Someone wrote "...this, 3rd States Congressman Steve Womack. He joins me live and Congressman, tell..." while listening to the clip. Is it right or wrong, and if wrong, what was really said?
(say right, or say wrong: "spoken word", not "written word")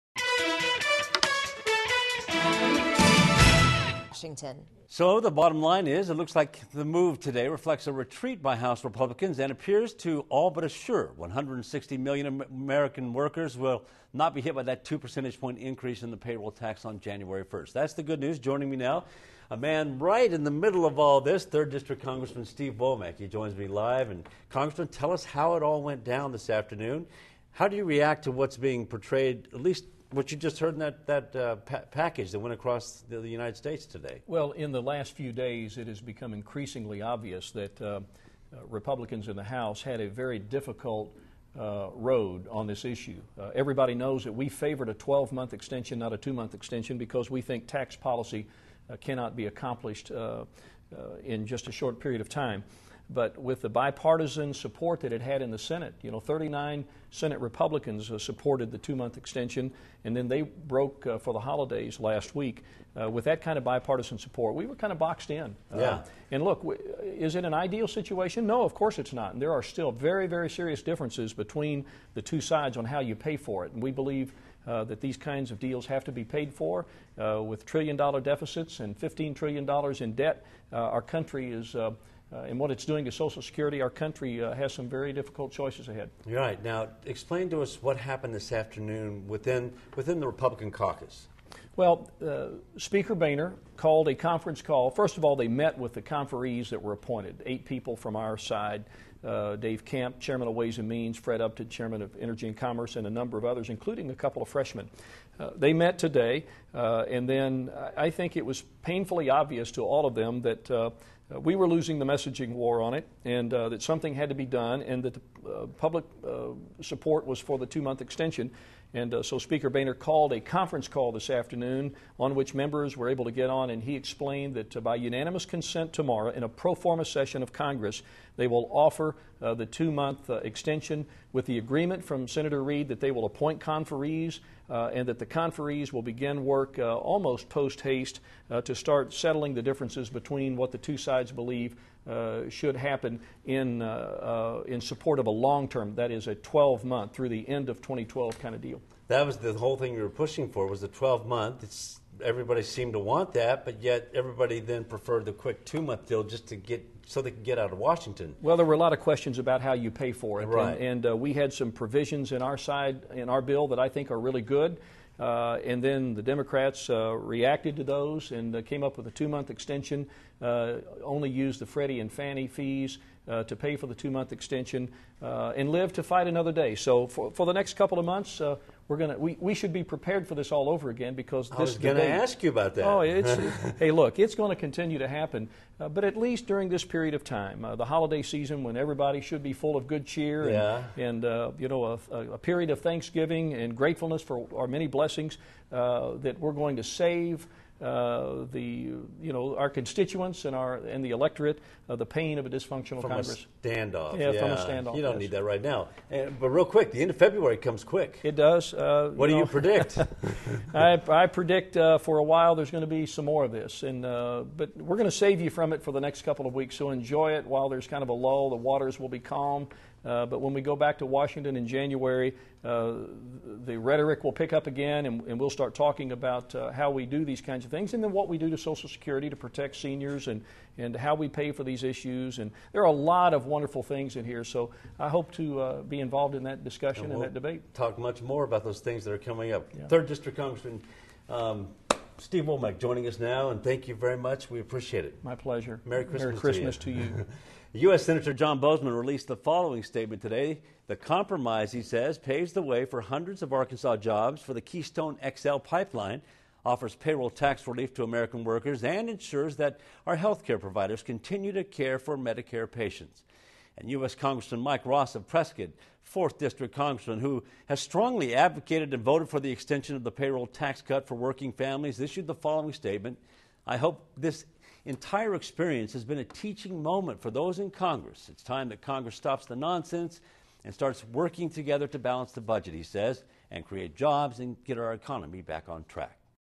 wrong: "District", not "States".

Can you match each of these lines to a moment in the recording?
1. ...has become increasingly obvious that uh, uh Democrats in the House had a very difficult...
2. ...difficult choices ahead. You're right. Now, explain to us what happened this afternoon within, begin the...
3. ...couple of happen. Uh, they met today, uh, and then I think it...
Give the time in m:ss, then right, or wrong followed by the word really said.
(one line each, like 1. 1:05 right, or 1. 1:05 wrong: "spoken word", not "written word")
1. 0:35 wrong: "Republicans", not "Democrats"
2. 1:25 wrong: "within", not "begin"
3. 1:44 wrong: "freshmen", not "happen".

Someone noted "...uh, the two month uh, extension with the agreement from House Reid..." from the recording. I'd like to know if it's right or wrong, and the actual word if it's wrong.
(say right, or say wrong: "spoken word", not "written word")
wrong: "Senator", not "House".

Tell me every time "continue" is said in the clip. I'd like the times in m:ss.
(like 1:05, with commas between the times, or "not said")
3:04, 4:21.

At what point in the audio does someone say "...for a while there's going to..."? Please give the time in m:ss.
3:31.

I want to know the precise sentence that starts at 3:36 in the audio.
So enjoy it while there's kind of a lull.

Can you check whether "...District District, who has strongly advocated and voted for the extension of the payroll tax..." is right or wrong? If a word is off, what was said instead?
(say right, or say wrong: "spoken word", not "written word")
wrong: "Congressman", not "District".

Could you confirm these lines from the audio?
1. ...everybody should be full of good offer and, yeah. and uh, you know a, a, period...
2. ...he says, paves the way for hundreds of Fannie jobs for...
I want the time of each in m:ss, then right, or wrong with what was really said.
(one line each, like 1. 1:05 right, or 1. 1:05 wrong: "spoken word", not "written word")
1. 3:08 wrong: "cheer", not "offer"
2. 4:11 wrong: "Arkansas", not "Fannie".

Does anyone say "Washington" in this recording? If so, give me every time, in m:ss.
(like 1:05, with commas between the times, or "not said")
0:04, 2:37, 3:41.